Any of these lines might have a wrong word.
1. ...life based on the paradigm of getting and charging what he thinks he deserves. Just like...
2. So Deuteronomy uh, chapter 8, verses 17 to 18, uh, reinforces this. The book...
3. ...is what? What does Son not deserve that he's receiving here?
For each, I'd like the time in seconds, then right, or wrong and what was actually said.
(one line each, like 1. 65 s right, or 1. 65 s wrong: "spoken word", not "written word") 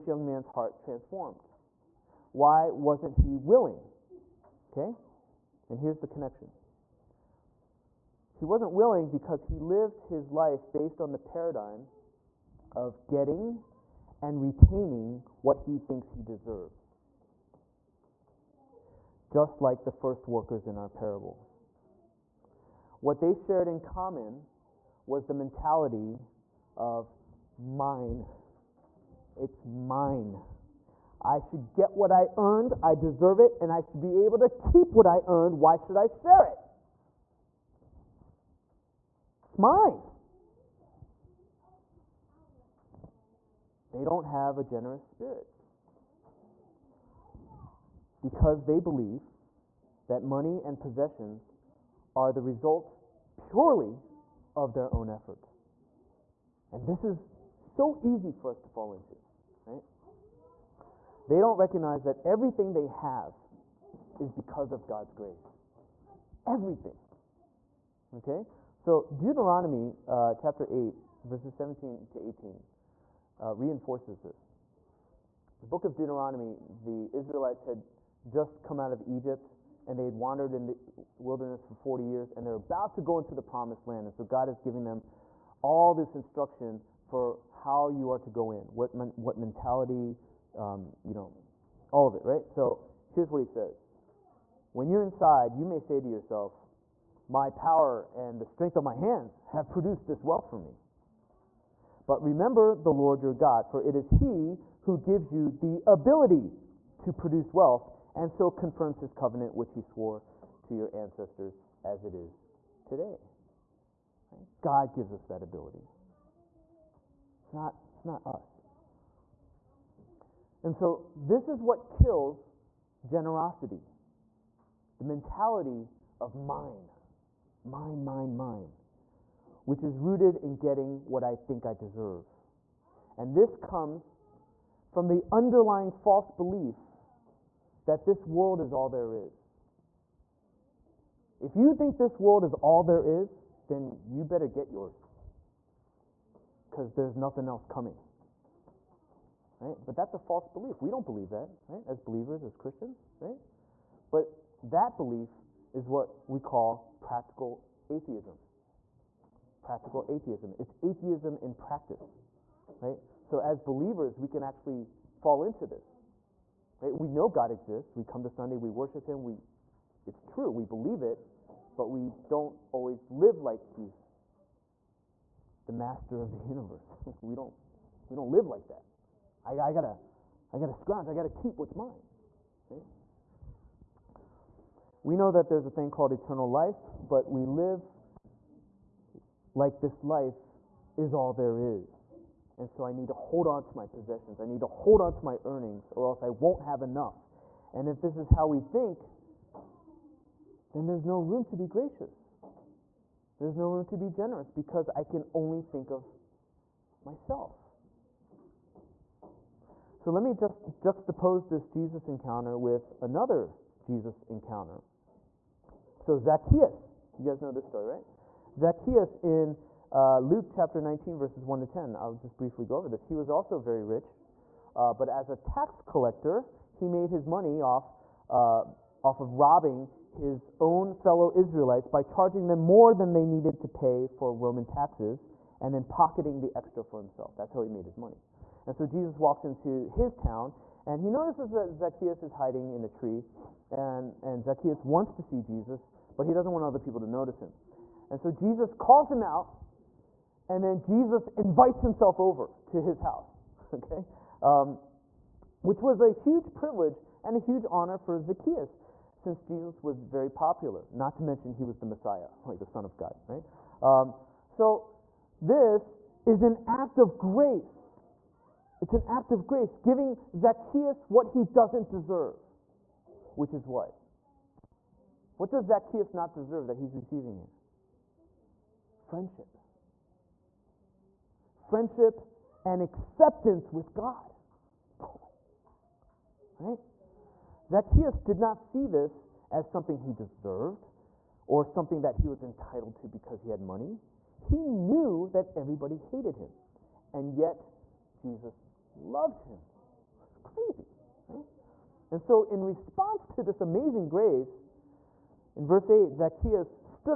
1. 10 s wrong: "retaining", not "charging"
2. 68 s right
3. 273 s wrong: "Zacchaeus", not "Son".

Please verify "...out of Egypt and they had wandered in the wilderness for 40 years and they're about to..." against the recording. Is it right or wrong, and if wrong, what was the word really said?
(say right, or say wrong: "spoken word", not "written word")
right.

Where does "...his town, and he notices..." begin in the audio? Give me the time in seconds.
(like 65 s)
239 s.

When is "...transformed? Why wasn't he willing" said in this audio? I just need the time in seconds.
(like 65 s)
0 s.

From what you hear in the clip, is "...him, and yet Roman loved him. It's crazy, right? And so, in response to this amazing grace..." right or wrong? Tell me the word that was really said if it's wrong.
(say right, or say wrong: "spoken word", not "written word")
wrong: "Jesus", not "Roman".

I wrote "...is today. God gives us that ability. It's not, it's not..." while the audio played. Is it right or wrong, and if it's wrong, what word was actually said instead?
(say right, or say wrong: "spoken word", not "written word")
right.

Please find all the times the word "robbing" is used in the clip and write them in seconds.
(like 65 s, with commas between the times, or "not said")
229 s.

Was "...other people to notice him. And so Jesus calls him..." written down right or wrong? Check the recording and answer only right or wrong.
right.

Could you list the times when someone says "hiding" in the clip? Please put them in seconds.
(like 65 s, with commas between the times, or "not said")
242 s.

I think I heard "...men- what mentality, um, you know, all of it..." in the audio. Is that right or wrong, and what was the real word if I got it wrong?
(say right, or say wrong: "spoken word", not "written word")
right.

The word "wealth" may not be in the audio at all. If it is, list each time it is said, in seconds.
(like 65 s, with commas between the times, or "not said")
100 s, 107 s.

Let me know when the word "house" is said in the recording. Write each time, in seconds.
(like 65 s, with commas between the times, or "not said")
253 s.